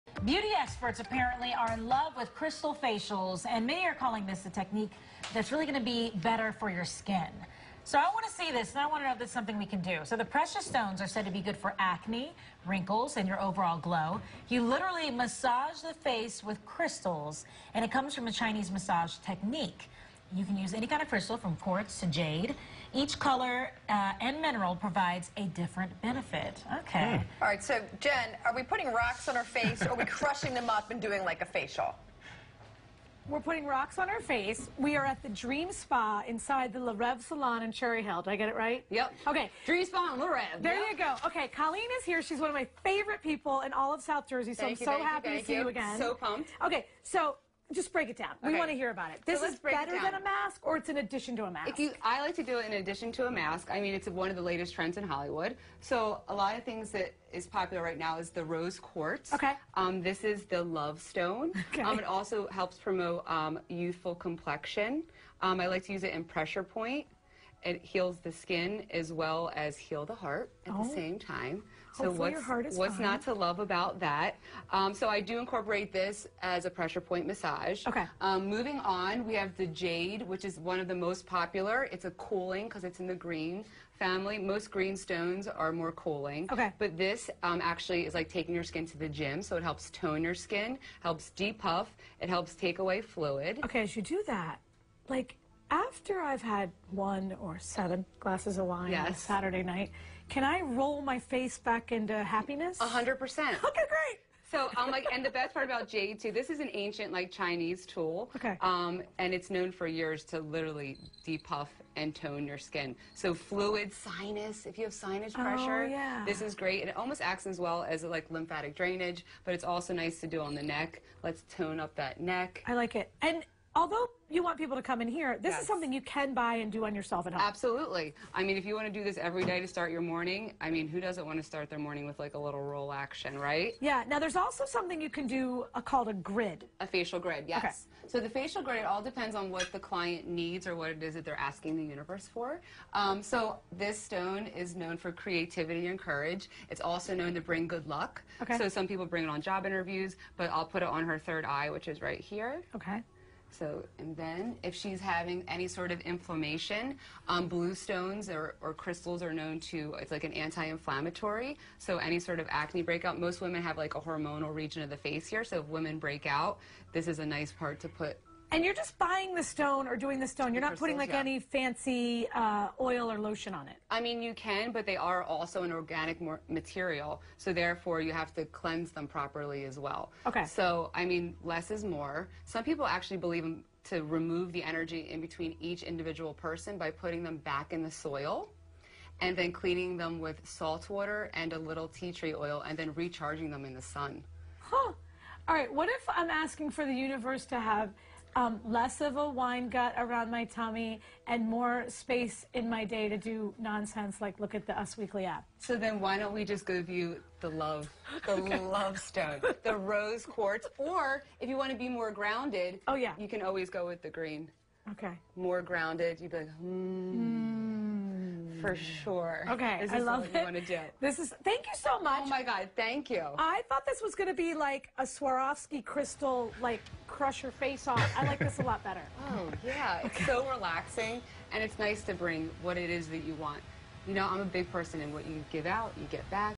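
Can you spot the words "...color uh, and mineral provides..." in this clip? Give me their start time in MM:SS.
00:23.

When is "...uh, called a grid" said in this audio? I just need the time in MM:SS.
02:15.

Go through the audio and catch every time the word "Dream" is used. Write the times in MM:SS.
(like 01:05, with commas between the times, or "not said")
00:35, 00:39.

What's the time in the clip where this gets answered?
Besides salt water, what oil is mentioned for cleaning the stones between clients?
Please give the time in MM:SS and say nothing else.
03:11.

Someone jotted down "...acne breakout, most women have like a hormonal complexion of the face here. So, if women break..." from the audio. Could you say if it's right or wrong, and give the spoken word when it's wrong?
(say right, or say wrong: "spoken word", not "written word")
wrong: "region", not "complexion".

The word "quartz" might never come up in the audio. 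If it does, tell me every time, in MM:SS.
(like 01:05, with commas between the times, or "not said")
00:21, 00:58, 03:30.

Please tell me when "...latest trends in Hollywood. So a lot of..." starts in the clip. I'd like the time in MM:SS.
00:54.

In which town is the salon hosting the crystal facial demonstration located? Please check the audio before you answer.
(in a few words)
Cherry Hill.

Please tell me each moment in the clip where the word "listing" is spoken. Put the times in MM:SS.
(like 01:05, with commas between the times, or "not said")
not said.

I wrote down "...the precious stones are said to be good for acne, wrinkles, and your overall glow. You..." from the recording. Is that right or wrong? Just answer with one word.
right.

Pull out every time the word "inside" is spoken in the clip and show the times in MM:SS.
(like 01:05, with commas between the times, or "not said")
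00:36.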